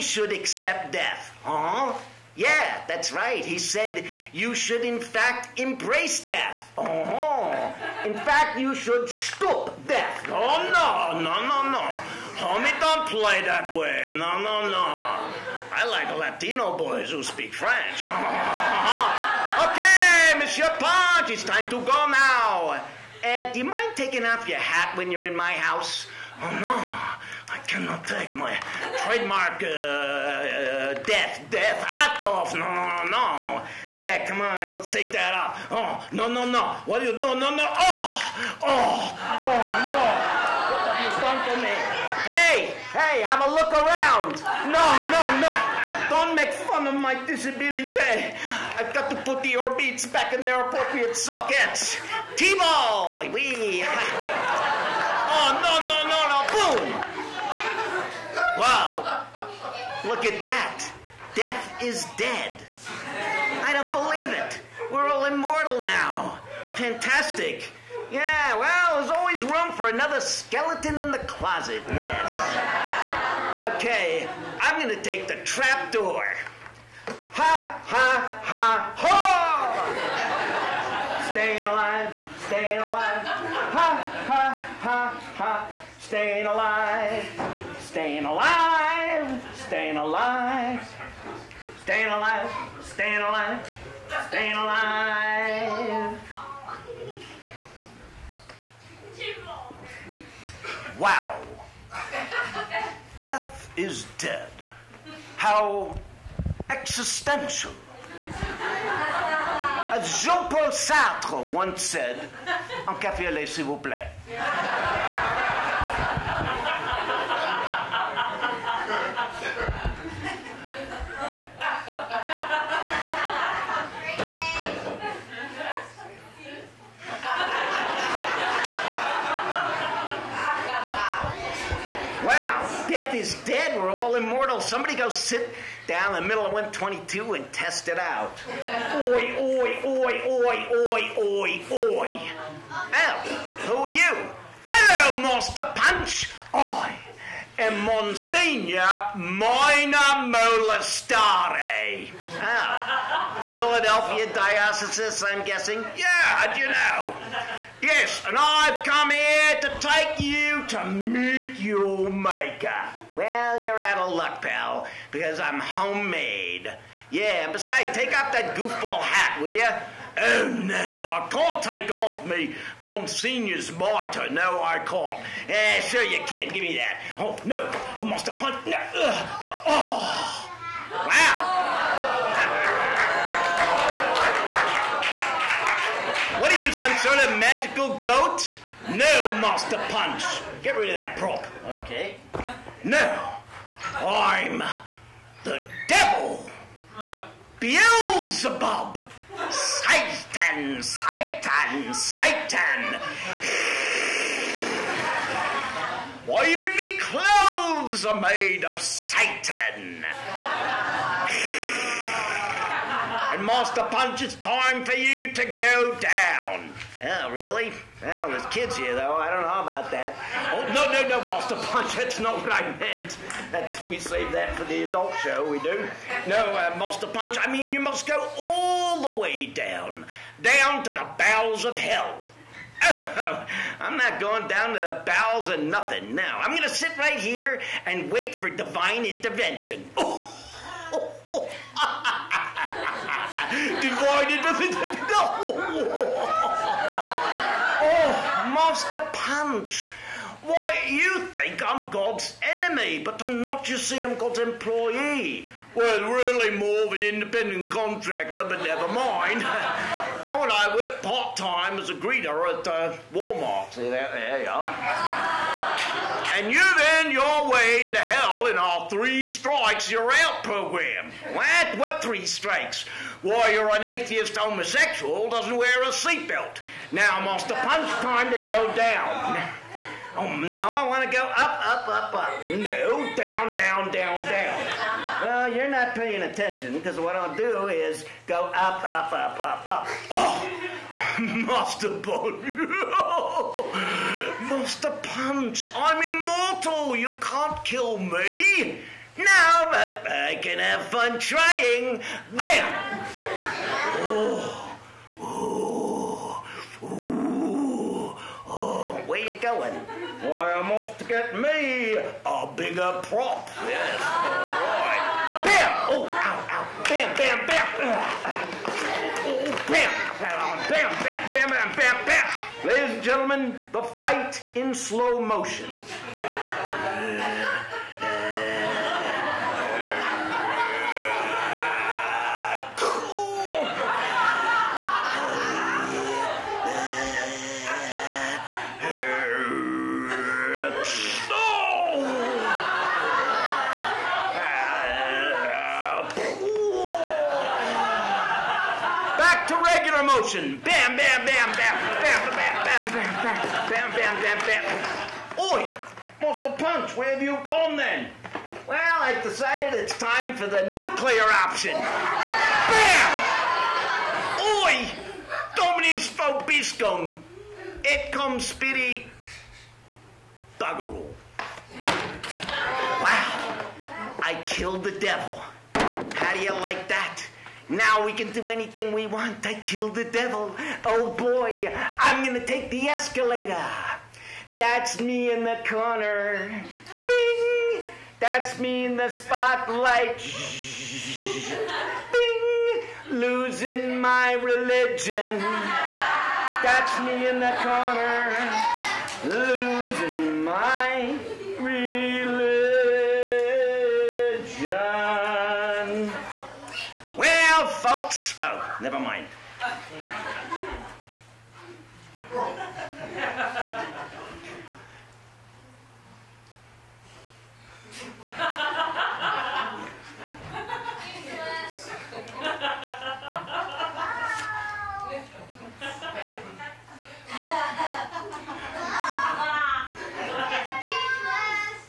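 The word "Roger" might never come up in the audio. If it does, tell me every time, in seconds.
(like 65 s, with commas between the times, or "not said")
not said.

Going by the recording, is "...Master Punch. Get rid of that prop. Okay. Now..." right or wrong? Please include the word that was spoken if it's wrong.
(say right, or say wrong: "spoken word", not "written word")
right.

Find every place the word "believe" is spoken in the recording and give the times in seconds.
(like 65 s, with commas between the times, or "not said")
63 s.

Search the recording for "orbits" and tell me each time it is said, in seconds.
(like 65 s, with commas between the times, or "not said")
49 s.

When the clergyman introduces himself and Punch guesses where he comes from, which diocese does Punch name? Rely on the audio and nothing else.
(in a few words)
Philadelphia.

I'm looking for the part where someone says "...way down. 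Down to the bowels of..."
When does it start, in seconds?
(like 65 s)
229 s.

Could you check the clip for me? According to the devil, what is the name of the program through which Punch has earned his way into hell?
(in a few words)
three strikes you're out.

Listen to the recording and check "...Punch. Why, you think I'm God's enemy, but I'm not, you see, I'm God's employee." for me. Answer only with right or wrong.
right.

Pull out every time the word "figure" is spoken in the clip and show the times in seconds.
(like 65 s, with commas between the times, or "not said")
not said.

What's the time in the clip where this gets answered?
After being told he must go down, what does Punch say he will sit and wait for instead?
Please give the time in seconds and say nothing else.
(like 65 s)
238 s.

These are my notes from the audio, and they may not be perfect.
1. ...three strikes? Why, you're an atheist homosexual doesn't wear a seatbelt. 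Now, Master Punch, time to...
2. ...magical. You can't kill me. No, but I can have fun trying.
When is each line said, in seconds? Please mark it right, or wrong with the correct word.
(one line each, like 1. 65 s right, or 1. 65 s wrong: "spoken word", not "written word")
1. 272 s right
2. 296 s wrong: "immortal", not "magical".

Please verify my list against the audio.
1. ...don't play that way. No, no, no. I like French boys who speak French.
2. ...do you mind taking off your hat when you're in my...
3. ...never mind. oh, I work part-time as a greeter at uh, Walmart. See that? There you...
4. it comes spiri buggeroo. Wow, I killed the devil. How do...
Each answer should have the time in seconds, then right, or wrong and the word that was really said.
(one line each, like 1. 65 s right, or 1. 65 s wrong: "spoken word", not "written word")
1. 12 s wrong: "Latino", not "French"
2. 23 s right
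3. 258 s right
4. 367 s right.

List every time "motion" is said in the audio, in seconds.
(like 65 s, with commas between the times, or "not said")
325 s, 350 s.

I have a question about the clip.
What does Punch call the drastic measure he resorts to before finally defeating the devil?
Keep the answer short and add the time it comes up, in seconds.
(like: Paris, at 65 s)
nuclear option, at 360 s.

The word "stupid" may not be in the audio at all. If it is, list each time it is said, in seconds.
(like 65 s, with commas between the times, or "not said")
not said.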